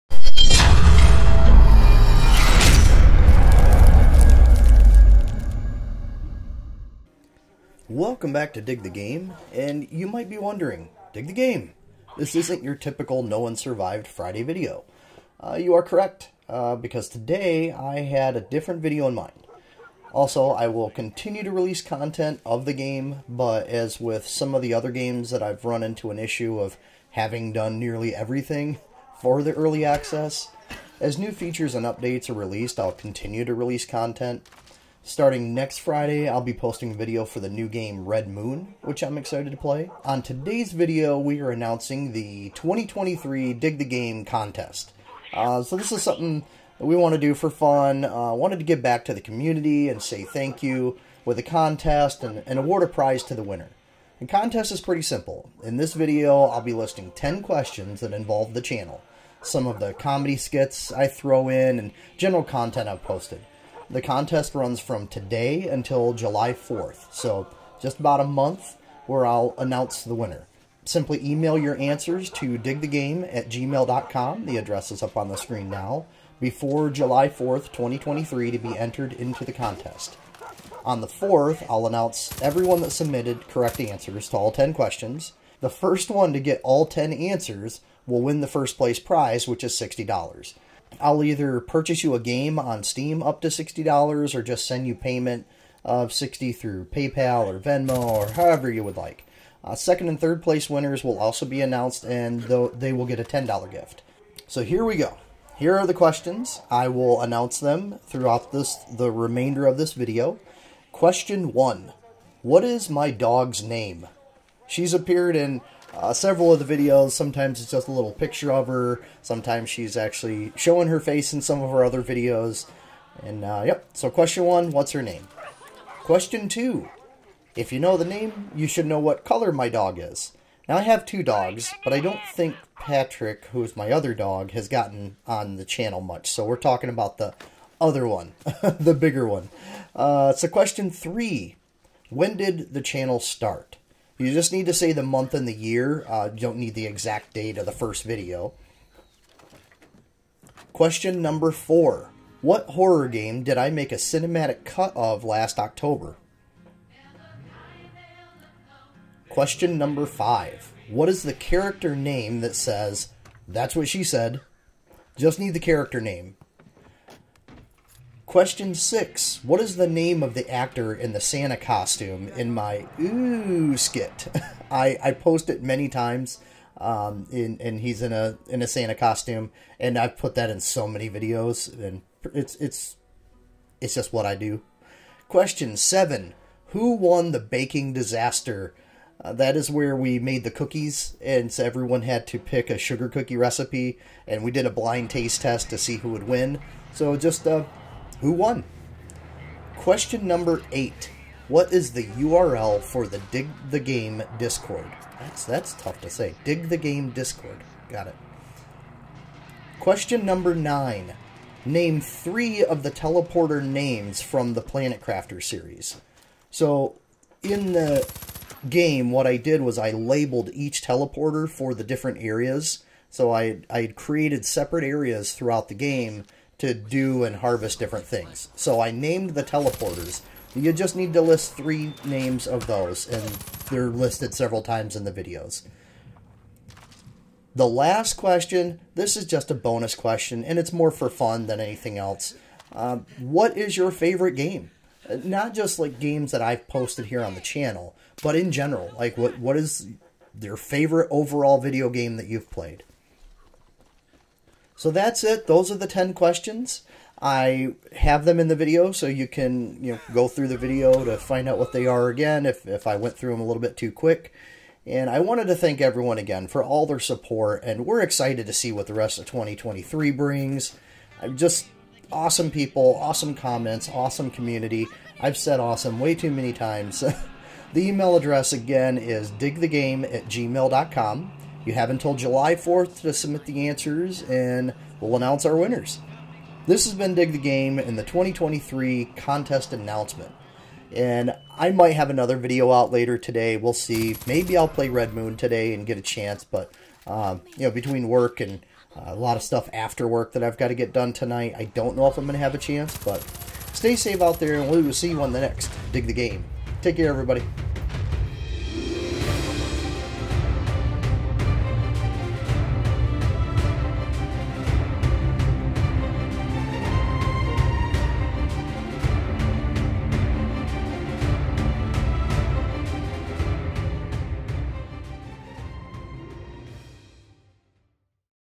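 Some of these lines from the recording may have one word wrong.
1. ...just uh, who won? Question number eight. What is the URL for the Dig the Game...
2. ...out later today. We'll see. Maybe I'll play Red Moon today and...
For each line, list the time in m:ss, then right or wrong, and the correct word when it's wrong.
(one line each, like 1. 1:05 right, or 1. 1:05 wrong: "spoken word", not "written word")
1. 3:17 right
2. 4:52 right.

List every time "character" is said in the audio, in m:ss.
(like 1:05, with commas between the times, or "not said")
2:41, 2:45.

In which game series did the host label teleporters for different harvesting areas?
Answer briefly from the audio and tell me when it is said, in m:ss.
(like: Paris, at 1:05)
Planet Crafter, at 3:34.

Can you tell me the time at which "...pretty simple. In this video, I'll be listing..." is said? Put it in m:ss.
0:54.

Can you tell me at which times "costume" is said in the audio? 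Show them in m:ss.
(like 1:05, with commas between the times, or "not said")
2:51, 2:58.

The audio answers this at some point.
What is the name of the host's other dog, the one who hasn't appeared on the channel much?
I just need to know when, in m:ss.
2:12.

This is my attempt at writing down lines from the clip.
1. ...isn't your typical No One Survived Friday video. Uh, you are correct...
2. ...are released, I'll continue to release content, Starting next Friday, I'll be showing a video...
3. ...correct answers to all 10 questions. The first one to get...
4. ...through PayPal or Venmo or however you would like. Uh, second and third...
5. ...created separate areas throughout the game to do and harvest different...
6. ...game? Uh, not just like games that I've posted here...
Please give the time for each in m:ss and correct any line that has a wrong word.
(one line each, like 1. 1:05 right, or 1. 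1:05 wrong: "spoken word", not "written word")
1. 0:12 right
2. 0:32 wrong: "posting", not "showing"
3. 1:23 right
4. 1:36 right
5. 3:43 right
6. 4:04 right.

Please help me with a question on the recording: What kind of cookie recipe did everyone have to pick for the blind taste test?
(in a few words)
sugar cookie.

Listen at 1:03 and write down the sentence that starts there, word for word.
The contest runs from today until July 4th, so just about a month where I'll announce the winner.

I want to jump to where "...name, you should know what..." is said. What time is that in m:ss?
2:08.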